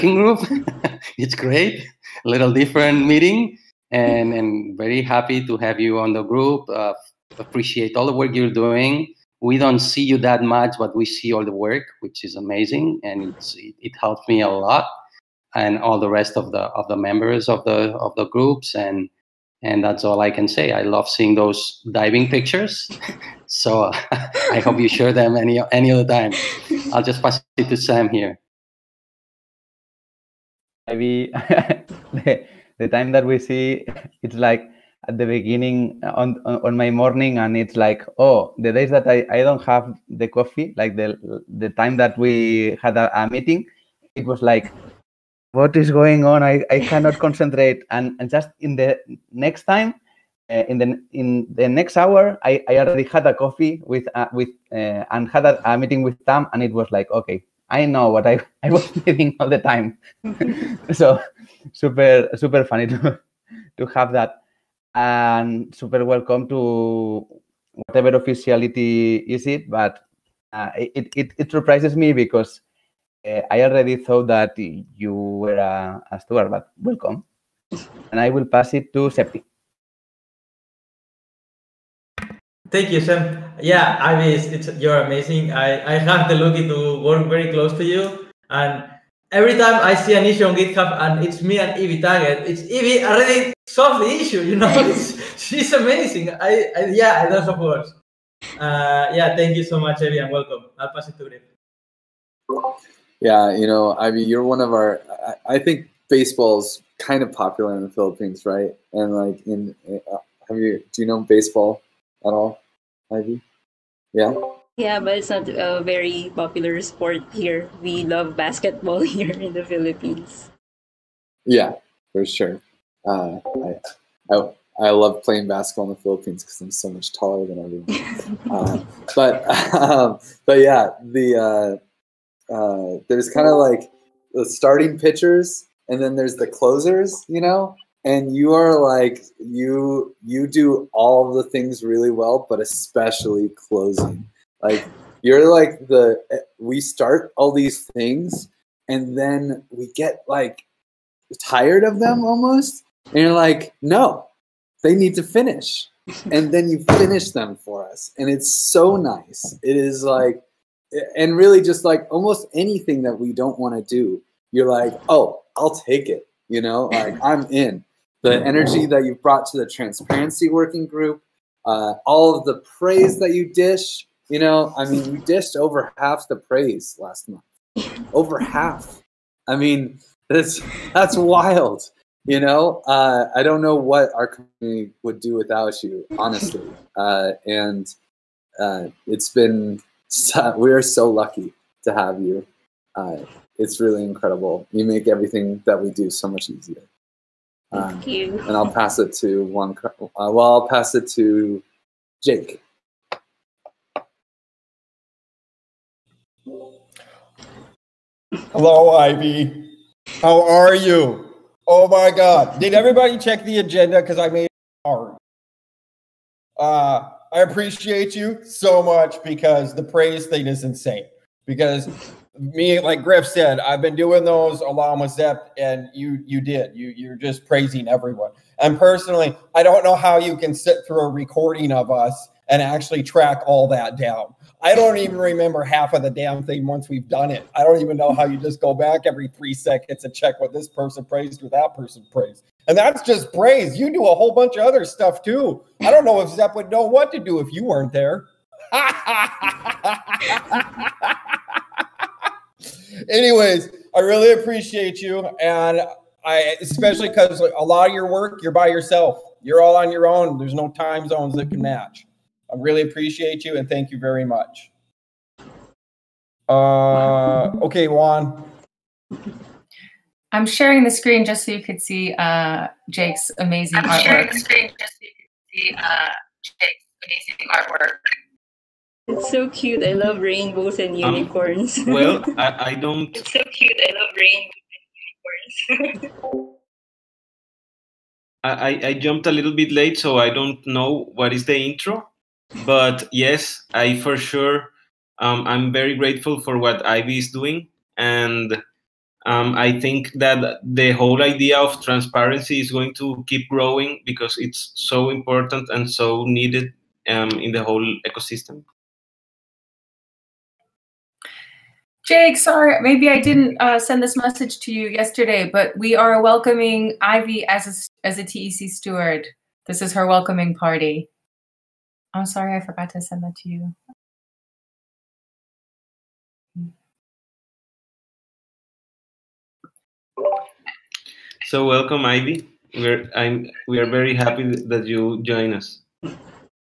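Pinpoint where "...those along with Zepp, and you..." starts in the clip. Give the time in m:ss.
3:44.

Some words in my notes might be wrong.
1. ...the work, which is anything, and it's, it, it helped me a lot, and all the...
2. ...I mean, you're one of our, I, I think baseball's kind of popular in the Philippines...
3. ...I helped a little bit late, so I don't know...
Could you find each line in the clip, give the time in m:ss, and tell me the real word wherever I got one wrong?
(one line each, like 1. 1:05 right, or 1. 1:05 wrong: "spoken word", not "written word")
1. 0:11 wrong: "amazing", not "anything"
2. 1:43 right
3. 4:48 wrong: "jumped", not "helped".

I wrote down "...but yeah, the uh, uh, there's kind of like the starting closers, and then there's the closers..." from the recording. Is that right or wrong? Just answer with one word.
wrong.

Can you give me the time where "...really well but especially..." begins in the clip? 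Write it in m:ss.
2:21.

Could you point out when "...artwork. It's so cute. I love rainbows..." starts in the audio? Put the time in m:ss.
4:37.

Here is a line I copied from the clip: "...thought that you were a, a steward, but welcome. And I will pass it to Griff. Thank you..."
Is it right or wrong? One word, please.
wrong.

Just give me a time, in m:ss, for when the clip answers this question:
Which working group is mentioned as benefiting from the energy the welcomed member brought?
2:49.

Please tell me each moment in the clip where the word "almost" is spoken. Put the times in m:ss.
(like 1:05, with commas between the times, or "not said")
2:32, 2:42.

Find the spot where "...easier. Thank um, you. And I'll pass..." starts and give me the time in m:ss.
3:16.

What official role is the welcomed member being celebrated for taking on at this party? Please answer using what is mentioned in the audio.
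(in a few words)
TEC steward.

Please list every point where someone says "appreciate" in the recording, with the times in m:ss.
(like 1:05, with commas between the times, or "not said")
0:07, 3:37, 4:14, 4:22.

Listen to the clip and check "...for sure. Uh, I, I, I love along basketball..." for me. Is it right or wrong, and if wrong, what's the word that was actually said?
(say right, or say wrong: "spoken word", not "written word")
wrong: "playing", not "along".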